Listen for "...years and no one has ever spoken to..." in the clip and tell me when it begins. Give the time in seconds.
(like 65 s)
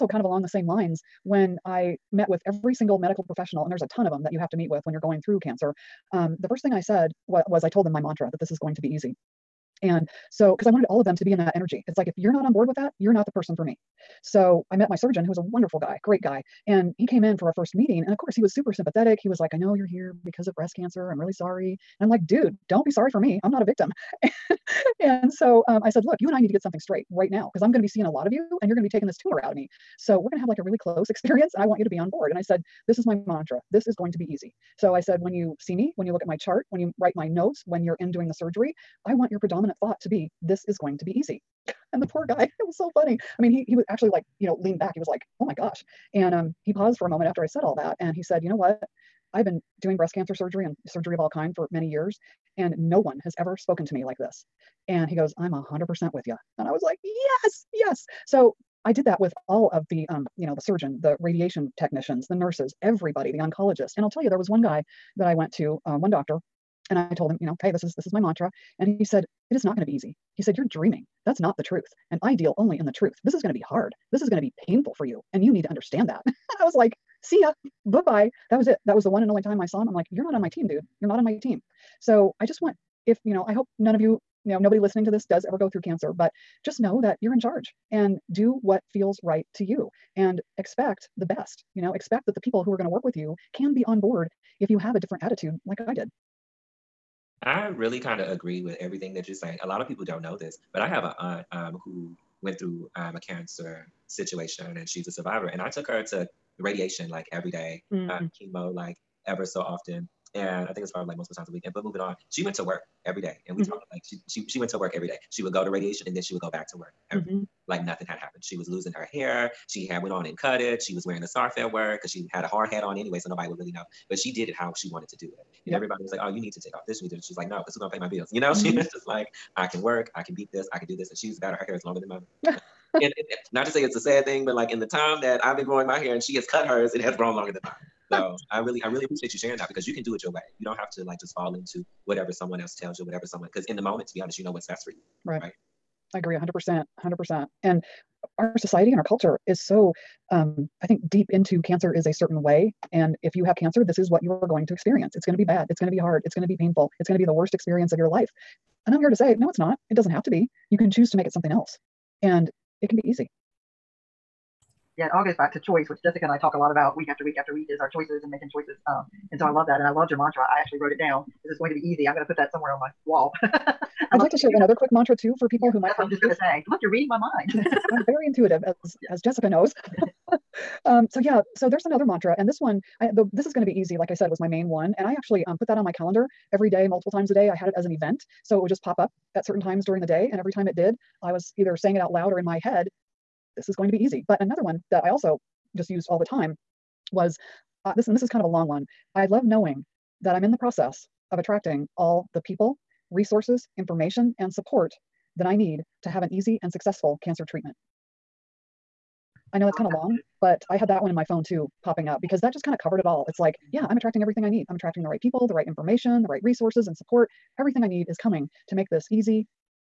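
51 s.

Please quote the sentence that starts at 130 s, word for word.
I can do this." And she's better.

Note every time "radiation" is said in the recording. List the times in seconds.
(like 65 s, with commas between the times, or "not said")
61 s, 106 s, 115 s.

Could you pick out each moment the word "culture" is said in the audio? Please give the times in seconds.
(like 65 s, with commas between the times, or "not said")
149 s.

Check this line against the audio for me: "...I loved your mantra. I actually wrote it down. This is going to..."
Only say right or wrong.
right.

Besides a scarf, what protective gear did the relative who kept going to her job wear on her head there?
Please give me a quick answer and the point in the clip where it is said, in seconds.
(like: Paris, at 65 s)
Hard hat, at 122 s.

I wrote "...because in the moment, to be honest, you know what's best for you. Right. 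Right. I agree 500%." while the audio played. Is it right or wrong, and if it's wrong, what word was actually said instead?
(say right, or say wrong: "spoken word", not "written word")
wrong: "100", not "500".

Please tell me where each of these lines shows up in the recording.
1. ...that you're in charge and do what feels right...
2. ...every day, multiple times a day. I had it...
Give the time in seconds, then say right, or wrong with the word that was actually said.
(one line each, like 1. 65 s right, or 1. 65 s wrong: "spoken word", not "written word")
1. 87 s right
2. 186 s right.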